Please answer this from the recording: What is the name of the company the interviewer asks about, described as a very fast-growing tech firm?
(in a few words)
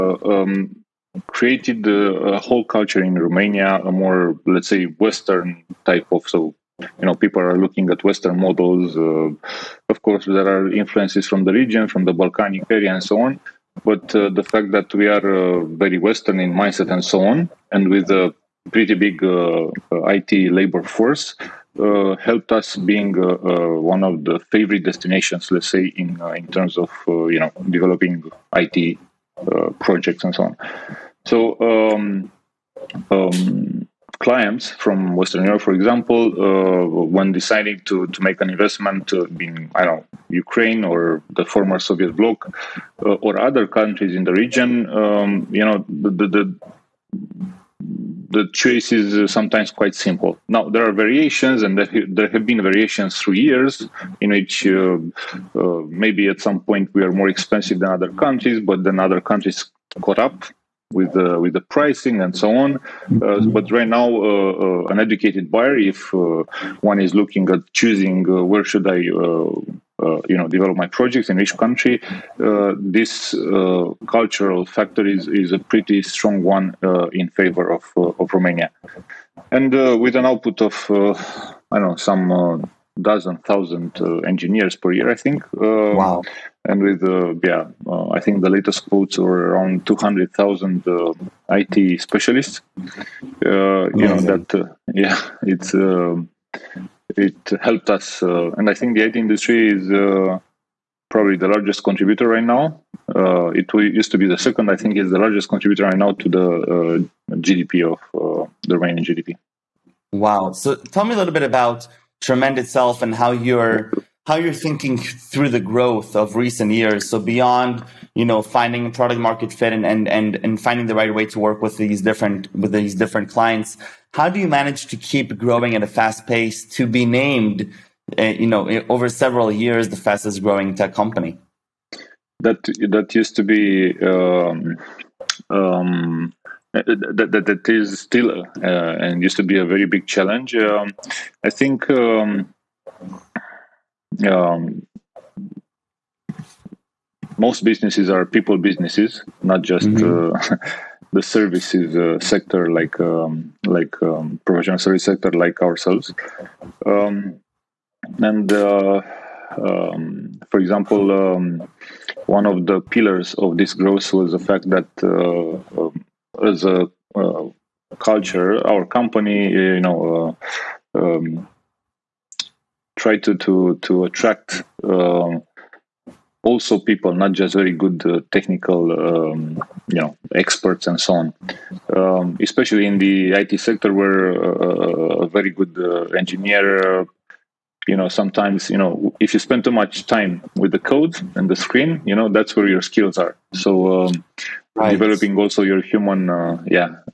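Tremend.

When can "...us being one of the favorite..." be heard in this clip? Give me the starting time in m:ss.
0:22.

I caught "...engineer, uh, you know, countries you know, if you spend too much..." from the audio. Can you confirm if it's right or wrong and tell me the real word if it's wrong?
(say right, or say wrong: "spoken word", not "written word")
wrong: "sometimes", not "countries".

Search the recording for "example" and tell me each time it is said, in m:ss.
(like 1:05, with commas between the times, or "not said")
0:35, 2:40.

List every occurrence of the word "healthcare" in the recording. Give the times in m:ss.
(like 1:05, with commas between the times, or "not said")
not said.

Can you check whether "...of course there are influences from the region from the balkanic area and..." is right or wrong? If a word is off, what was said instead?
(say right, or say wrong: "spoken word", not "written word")
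right.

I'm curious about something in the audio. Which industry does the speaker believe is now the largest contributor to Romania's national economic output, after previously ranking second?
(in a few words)
IT industry.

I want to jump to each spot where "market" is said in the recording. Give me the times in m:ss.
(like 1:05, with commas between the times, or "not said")
1:59.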